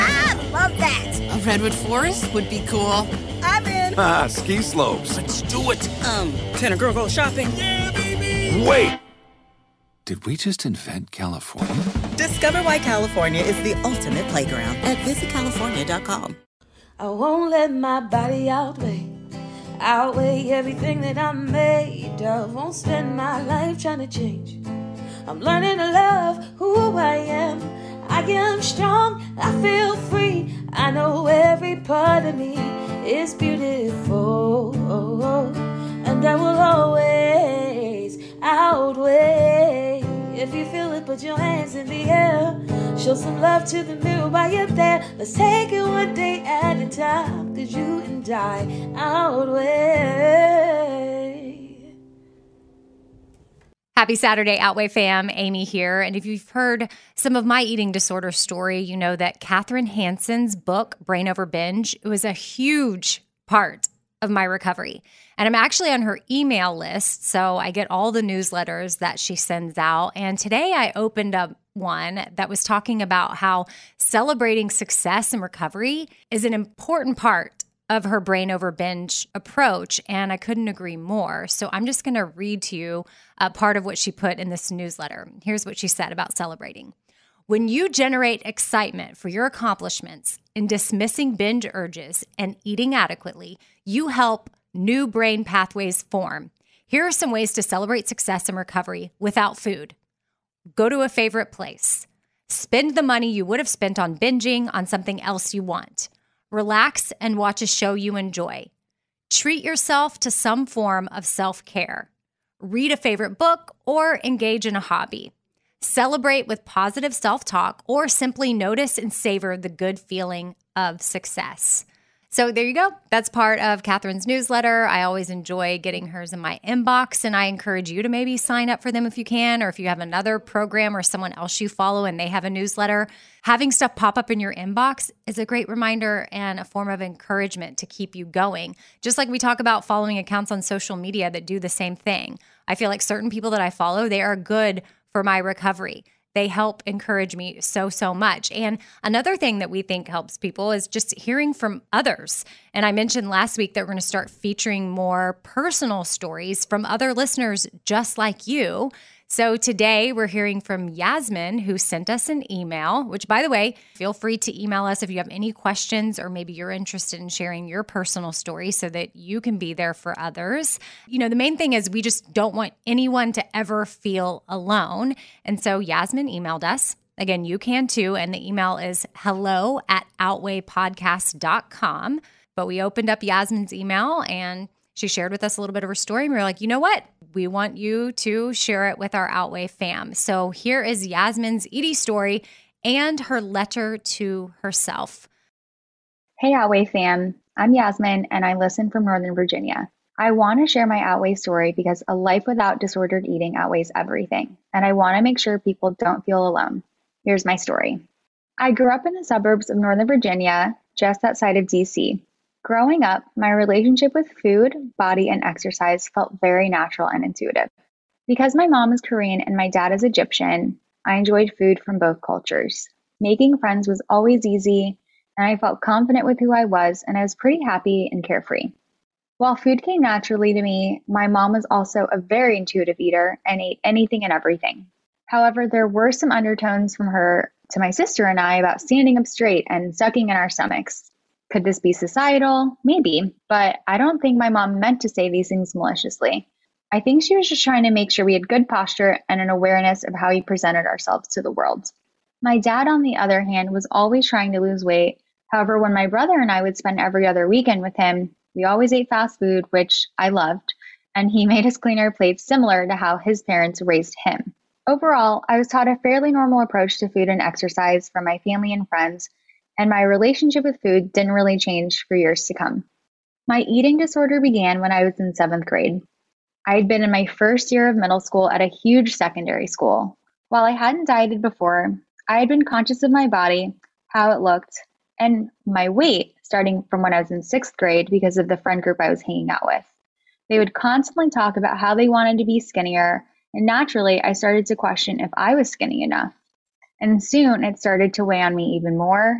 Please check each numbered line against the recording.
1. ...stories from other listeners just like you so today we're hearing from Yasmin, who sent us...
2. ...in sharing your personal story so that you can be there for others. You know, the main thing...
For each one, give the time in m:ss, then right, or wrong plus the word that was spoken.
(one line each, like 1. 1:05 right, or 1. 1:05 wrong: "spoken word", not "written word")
1. 2:36 right
2. 2:47 right.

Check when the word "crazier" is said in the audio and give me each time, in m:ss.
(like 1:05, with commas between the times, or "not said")
not said.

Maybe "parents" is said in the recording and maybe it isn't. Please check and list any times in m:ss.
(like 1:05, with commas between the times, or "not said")
4:23.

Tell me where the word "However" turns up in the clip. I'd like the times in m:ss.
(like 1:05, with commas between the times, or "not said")
3:55, 4:15.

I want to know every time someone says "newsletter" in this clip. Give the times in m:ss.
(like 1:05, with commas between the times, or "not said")
1:08, 1:24, 2:04, 2:12.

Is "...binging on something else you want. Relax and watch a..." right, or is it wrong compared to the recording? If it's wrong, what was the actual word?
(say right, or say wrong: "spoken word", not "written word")
right.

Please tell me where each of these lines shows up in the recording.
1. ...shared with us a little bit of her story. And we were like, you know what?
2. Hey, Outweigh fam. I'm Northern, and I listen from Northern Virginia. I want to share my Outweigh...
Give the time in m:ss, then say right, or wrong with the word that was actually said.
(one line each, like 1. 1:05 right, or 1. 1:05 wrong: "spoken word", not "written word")
1. 3:05 right
2. 3:16 wrong: "Yasmin", not "Northern".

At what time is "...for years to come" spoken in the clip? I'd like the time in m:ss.
4:32.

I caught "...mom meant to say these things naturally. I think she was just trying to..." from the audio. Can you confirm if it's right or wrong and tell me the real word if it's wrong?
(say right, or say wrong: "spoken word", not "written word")
wrong: "maliciously", not "naturally".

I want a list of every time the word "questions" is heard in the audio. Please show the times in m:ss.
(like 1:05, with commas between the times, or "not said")
2:45, 4:54.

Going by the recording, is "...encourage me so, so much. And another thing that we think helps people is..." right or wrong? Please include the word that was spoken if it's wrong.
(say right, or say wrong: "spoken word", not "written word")
right.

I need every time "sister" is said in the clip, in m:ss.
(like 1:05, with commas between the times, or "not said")
3:57.